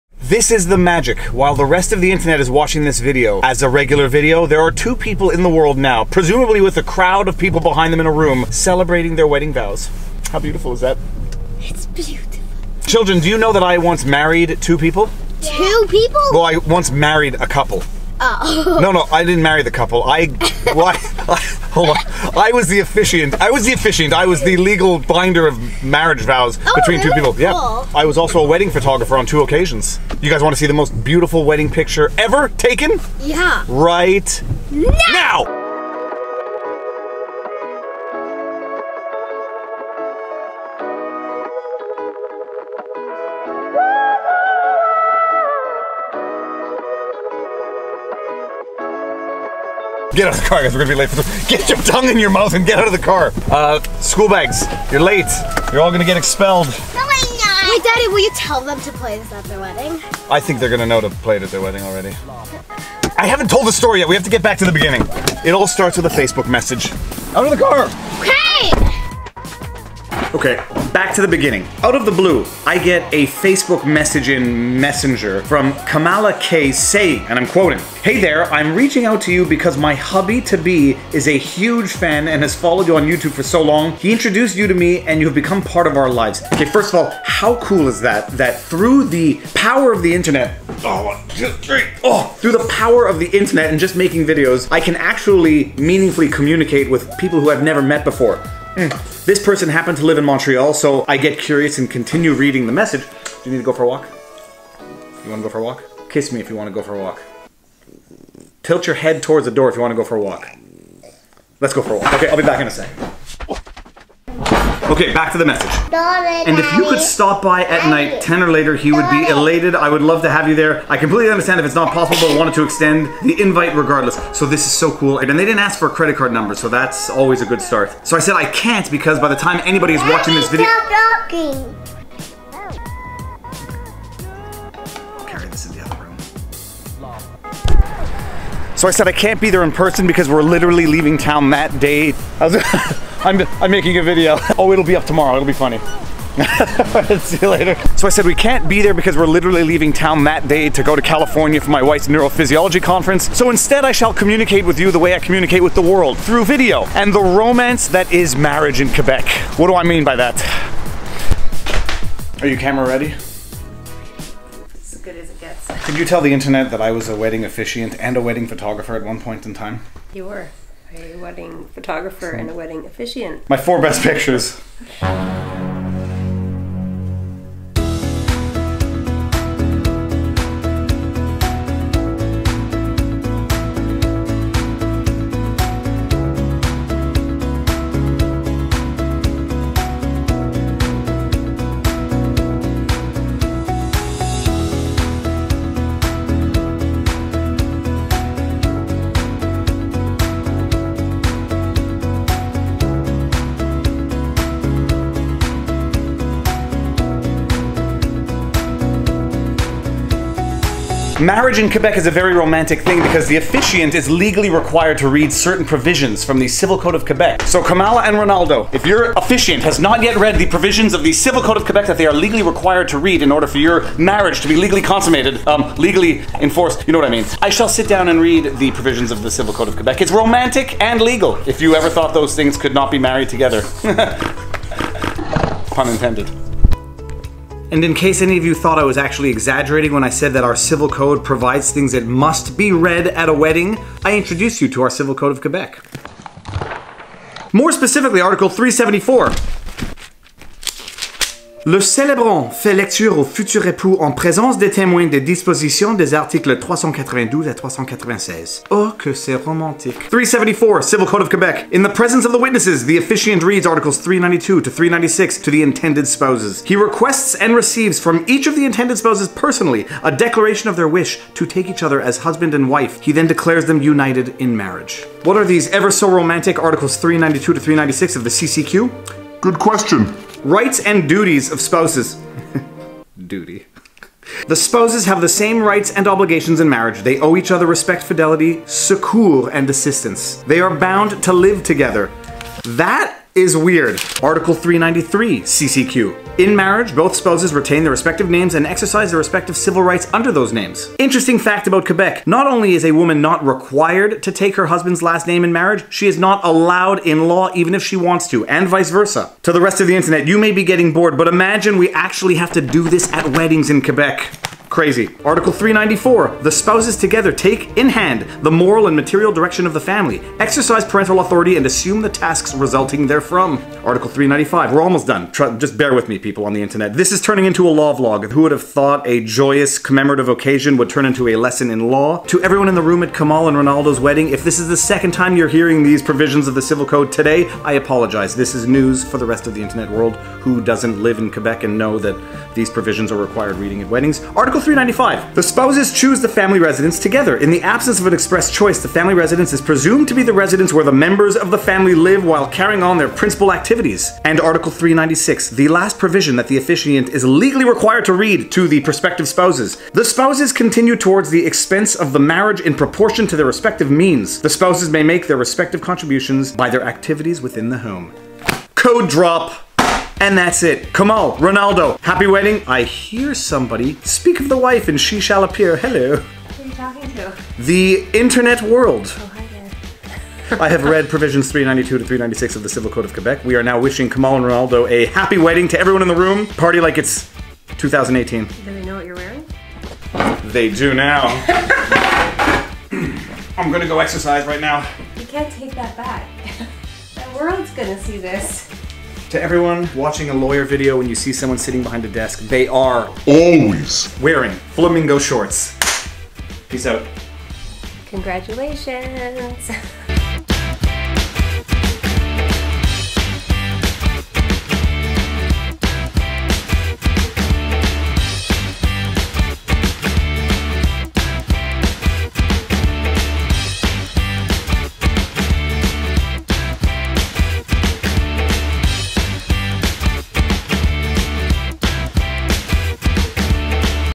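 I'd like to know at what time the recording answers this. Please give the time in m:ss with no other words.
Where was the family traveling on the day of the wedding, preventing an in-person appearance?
2:31.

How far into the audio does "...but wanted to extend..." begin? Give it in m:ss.
2:02.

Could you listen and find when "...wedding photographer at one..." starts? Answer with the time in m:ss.
2:48.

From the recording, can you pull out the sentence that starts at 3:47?
I shall sit down and read the provisions of the Civil Code of Quebec.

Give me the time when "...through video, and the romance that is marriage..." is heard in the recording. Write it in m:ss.
2:36.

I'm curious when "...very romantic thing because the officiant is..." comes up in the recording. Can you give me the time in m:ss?
3:32.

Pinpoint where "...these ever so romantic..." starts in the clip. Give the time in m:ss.
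4:35.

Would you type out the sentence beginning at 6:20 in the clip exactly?
I have read provisions 392 to 396 of the Civil Code of Quebec.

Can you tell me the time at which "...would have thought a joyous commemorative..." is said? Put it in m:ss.
5:28.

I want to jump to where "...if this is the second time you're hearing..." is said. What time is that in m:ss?
5:34.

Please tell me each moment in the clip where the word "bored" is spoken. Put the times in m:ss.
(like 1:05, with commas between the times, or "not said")
5:10.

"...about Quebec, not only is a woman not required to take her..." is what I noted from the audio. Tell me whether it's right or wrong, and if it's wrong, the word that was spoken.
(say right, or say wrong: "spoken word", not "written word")
right.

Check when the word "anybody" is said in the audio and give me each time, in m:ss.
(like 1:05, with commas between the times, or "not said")
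2:09.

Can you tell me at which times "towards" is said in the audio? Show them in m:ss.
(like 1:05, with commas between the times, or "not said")
1:49, 6:00.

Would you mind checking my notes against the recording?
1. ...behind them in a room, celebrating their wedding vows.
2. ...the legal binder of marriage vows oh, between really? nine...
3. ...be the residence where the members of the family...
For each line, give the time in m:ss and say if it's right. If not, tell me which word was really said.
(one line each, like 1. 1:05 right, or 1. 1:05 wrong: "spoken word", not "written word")
1. 0:07 right
2. 0:24 wrong: "two", not "nine"
3. 5:50 right.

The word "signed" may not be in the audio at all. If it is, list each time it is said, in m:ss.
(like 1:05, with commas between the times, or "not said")
not said.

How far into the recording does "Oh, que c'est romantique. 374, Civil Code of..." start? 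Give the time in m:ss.
4:18.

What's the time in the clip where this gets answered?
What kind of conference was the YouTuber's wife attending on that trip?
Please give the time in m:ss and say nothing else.
2:32.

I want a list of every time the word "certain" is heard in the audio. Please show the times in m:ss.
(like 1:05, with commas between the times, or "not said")
3:35.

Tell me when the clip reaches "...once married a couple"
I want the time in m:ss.
0:16.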